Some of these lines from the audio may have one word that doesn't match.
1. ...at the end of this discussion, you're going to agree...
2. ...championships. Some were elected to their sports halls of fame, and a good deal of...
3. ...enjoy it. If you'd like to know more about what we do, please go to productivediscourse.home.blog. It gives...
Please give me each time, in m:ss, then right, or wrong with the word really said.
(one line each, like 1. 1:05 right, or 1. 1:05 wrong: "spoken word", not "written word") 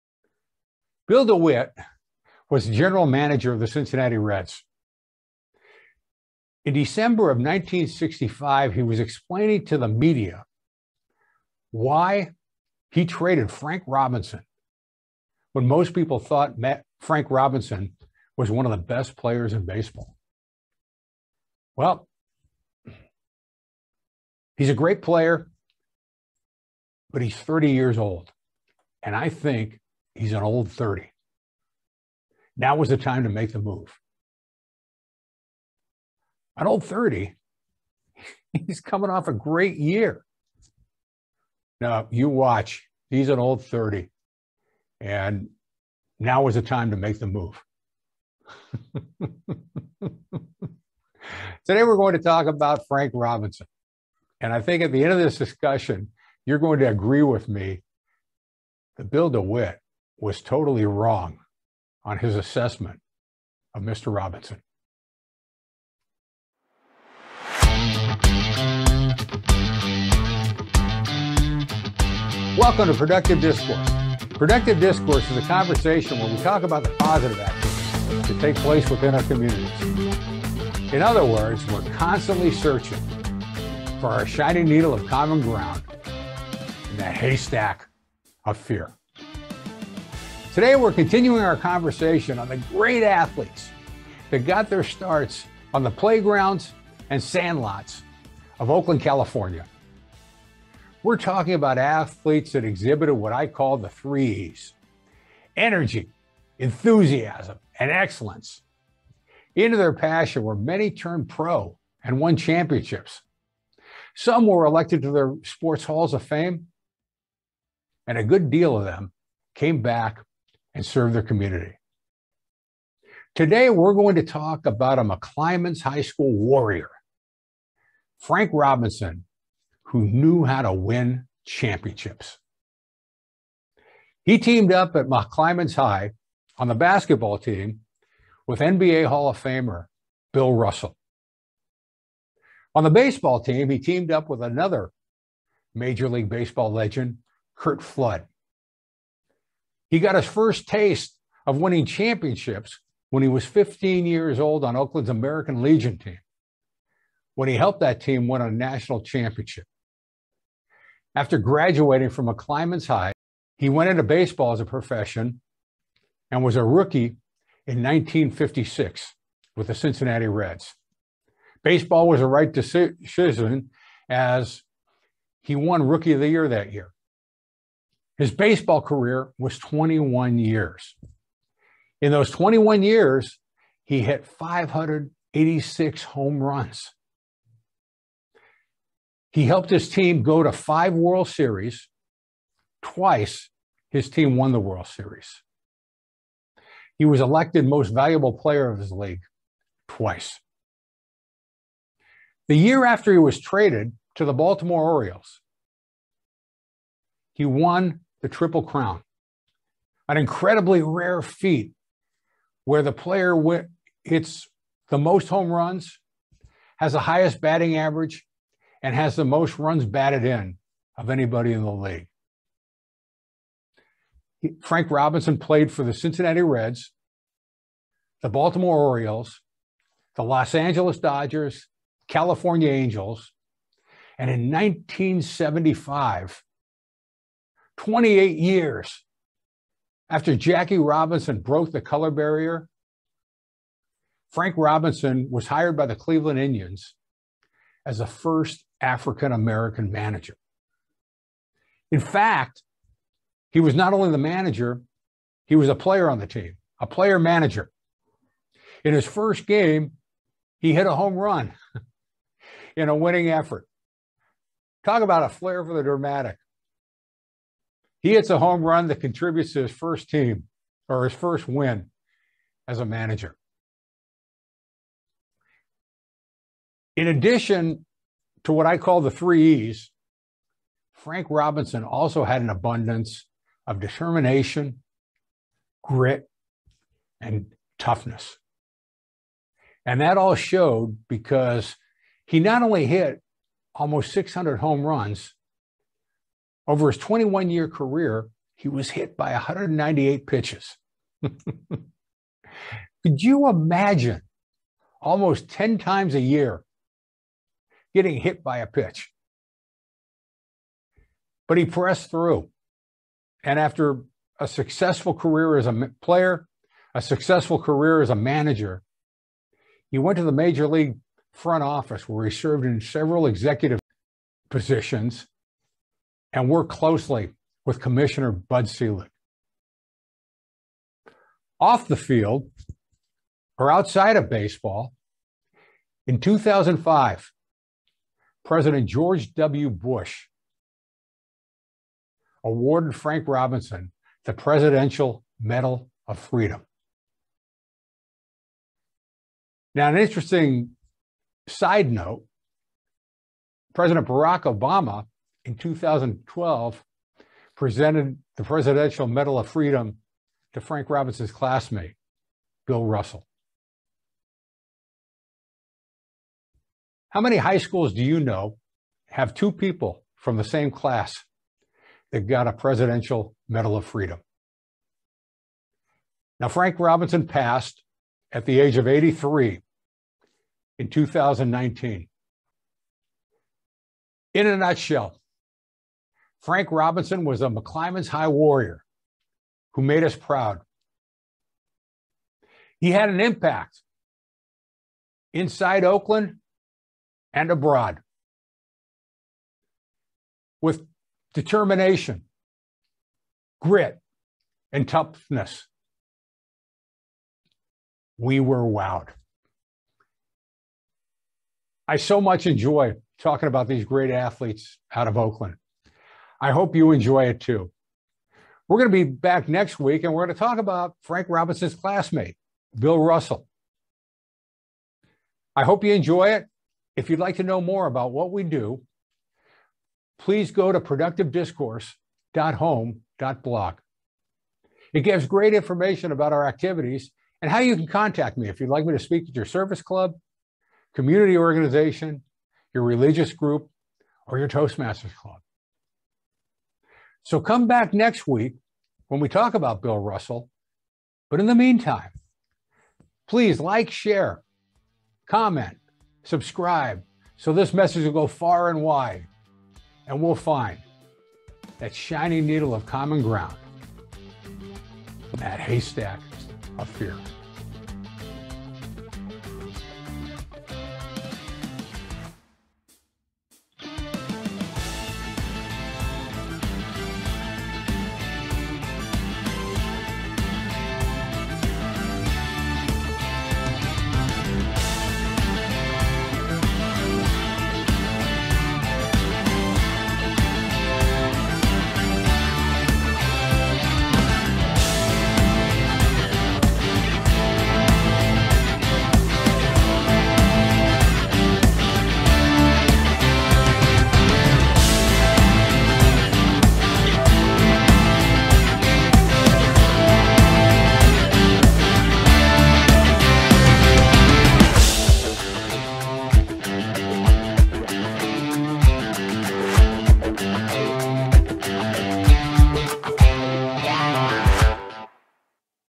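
1. 0:54 right
2. 1:52 right
3. 7:05 right.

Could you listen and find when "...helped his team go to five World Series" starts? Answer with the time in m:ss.
3:09.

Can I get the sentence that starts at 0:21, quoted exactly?
Well, he's a great player, but he's 30 years old.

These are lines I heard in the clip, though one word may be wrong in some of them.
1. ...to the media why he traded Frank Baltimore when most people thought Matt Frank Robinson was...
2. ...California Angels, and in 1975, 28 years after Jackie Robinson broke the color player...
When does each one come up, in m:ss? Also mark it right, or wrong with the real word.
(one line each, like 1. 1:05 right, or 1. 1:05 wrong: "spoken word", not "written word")
1. 0:09 wrong: "Robinson", not "Baltimore"
2. 3:52 wrong: "barrier", not "player".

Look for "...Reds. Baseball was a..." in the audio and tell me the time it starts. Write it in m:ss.
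2:50.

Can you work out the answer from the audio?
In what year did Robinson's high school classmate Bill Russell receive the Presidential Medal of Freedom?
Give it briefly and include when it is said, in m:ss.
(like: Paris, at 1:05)
2012, at 5:55.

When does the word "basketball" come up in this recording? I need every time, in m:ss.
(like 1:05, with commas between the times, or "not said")
2:16.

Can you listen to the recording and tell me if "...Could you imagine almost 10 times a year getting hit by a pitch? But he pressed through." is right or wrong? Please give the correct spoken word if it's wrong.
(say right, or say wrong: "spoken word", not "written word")
right.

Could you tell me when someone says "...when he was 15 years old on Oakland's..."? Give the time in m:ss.
2:33.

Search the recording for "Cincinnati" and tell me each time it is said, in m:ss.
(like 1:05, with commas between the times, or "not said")
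0:03, 2:49, 3:45.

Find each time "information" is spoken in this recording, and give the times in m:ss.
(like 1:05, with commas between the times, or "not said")
7:15.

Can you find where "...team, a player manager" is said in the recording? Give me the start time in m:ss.
4:16.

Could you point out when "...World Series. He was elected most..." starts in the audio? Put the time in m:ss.
3:14.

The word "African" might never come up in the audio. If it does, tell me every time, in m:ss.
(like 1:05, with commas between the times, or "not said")
4:08.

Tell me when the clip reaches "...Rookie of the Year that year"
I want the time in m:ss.
2:55.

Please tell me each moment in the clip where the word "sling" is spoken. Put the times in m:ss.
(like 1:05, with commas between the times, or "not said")
not said.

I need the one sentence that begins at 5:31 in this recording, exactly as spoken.
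Off the field or outside of baseball, in 2005, President George W.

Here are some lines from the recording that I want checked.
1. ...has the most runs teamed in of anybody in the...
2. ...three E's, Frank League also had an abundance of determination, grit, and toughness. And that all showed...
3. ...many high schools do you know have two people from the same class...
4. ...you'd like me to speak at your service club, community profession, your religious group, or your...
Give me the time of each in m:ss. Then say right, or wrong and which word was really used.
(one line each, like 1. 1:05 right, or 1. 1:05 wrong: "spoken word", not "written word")
1. 3:38 wrong: "batted", not "teamed"
2. 4:39 wrong: "Robinson", not "League"
3. 6:07 right
4. 7:18 wrong: "organization", not "profession".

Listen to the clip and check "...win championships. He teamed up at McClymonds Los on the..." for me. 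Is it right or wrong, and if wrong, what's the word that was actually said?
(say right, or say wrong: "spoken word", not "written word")
wrong: "High", not "Los".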